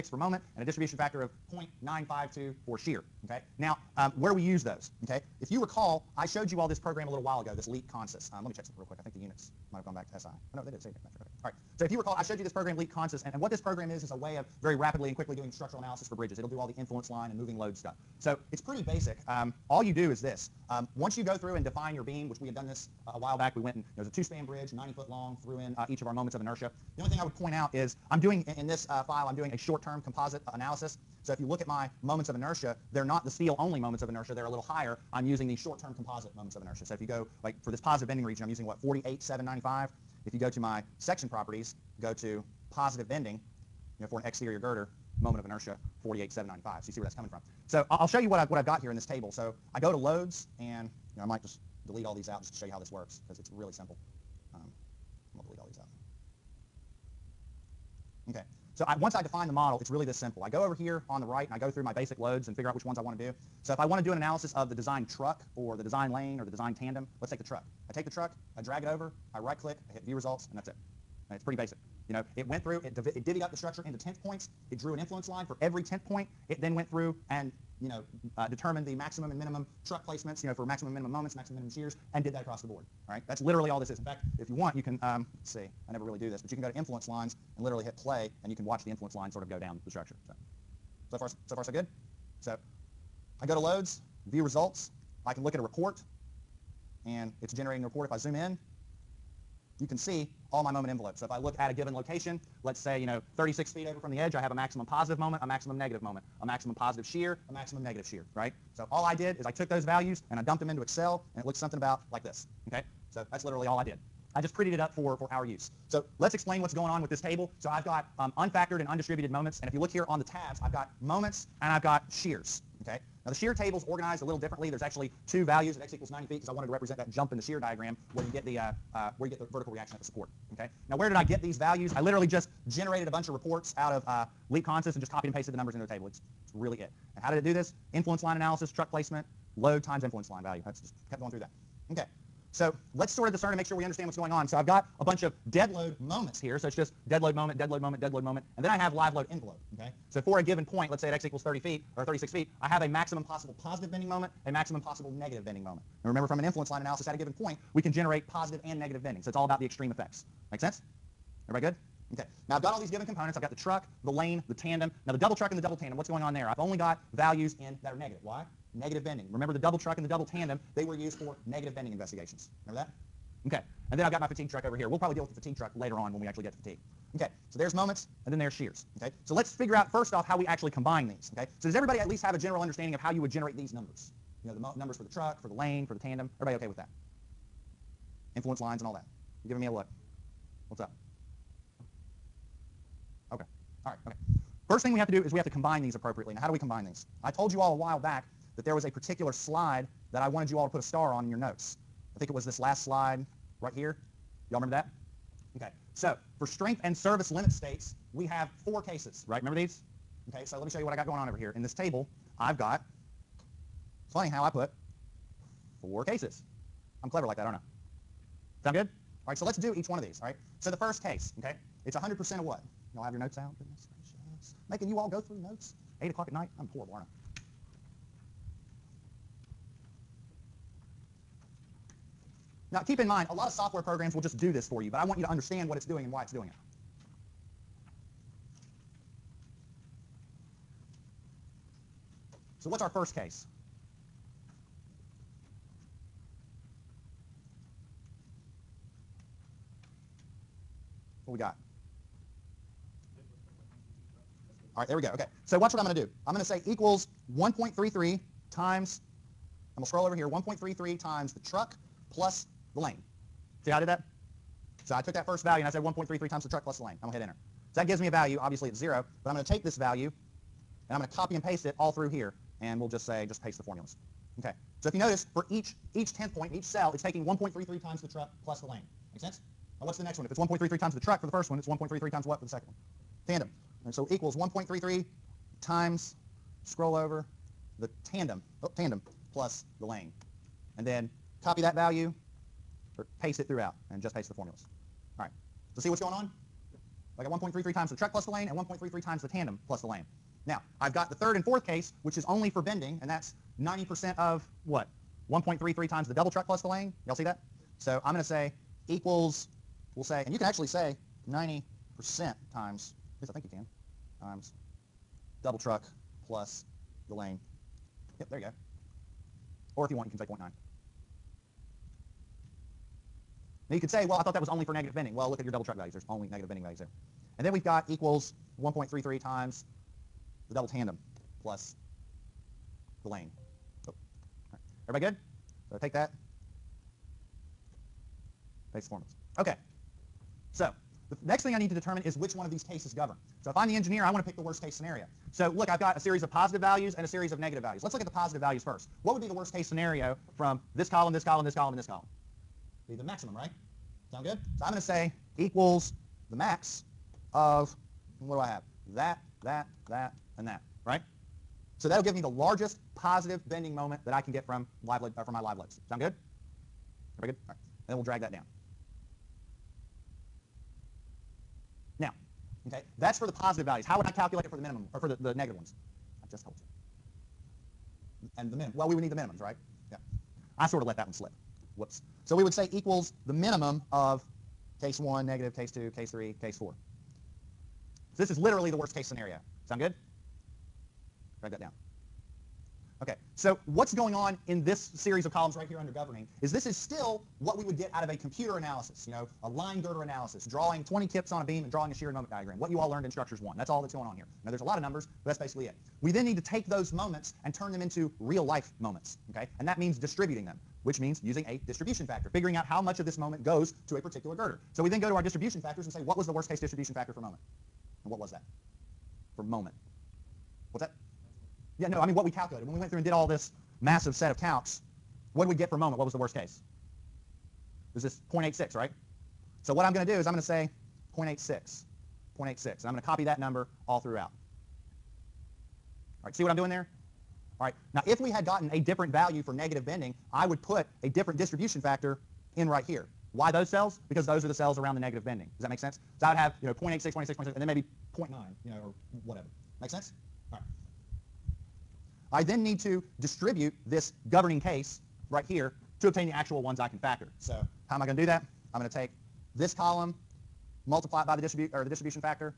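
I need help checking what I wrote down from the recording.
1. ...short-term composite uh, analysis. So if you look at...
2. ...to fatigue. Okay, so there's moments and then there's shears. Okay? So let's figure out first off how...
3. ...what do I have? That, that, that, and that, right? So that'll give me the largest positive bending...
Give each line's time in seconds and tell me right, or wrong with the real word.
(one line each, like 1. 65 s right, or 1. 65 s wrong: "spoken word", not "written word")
1. 29 s right
2. 176 s right
3. 358 s right.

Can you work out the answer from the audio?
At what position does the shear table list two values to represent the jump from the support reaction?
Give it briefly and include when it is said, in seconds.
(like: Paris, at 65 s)
90 feet, at 125 s.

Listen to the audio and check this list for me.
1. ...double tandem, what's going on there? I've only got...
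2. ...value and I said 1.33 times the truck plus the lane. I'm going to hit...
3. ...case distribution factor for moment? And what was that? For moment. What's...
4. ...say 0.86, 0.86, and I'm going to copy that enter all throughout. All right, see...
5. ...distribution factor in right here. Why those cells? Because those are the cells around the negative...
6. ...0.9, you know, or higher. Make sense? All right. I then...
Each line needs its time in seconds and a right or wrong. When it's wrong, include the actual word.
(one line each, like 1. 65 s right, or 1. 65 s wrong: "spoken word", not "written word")
1. 165 s right
2. 265 s right
3. 416 s right
4. 430 s wrong: "number", not "enter"
5. 441 s right
6. 448 s wrong: "whatever", not "higher".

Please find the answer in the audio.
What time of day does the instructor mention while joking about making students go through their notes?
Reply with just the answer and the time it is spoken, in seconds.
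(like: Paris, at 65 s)
8 o'clock at night, at 226 s.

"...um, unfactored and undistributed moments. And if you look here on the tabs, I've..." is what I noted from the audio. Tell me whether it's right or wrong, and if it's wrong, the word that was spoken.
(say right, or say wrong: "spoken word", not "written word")
right.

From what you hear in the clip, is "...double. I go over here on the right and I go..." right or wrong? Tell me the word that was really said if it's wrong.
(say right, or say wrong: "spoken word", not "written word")
wrong: "simple", not "double".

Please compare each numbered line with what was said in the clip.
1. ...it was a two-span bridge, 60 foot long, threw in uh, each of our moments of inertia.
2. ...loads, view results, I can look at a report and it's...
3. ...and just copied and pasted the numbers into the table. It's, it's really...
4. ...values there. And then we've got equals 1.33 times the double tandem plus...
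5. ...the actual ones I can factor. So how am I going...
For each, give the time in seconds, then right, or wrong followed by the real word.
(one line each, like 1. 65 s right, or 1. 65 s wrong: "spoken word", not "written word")
1. 24 s wrong: "90", not "60"
2. 93 s right
3. 134 s right
4. 326 s right
5. 456 s right.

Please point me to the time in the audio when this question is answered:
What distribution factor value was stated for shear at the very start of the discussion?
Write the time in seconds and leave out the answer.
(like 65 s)
1 s.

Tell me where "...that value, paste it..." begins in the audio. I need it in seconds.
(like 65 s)
291 s.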